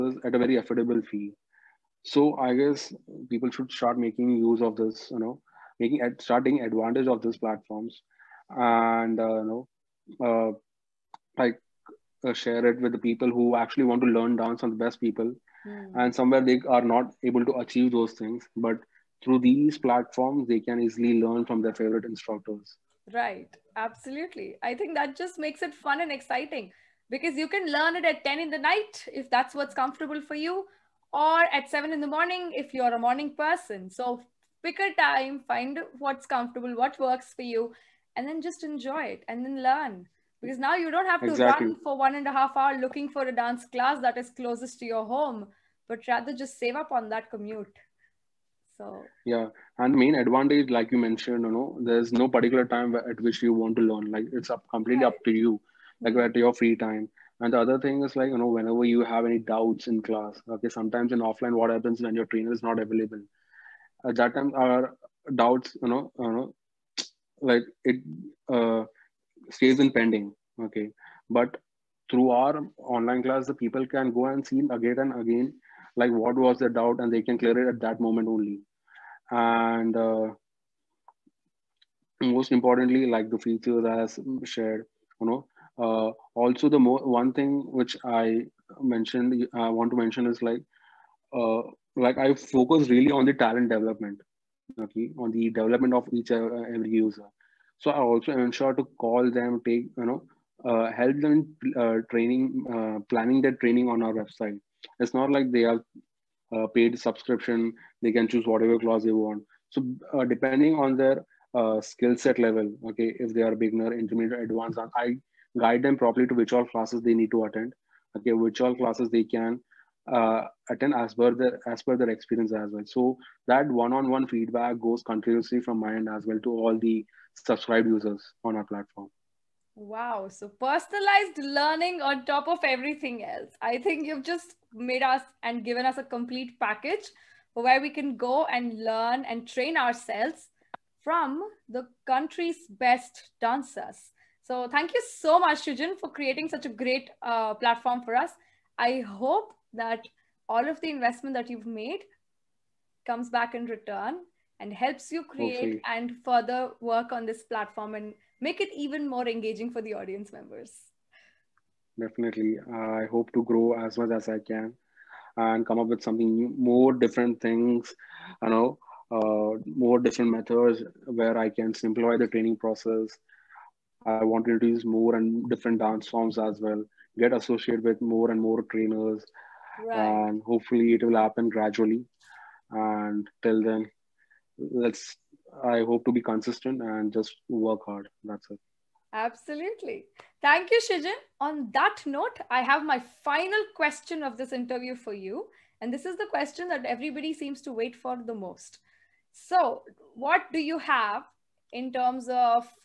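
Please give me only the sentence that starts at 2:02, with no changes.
So that one-on-one -on -one feedback goes continuously from my end as well to all the subscribed users on our platform.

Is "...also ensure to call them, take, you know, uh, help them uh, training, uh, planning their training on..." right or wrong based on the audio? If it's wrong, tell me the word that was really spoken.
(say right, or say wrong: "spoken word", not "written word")
right.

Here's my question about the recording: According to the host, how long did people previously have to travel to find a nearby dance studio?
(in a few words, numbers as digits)
1.5 hours.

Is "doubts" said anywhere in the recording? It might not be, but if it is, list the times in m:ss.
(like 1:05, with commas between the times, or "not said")
0:59, 1:05, 1:16.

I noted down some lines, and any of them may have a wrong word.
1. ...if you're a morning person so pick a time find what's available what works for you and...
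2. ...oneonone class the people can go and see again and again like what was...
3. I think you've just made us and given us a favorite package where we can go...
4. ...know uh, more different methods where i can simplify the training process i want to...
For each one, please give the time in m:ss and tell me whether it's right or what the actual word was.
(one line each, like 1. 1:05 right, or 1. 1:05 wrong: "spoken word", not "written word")
1. 0:32 wrong: "comfortable", not "available"
2. 1:12 wrong: "online", not "oneonone"
3. 2:13 wrong: "complete", not "favorite"
4. 2:48 right.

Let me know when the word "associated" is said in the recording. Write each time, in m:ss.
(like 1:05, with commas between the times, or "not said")
2:57.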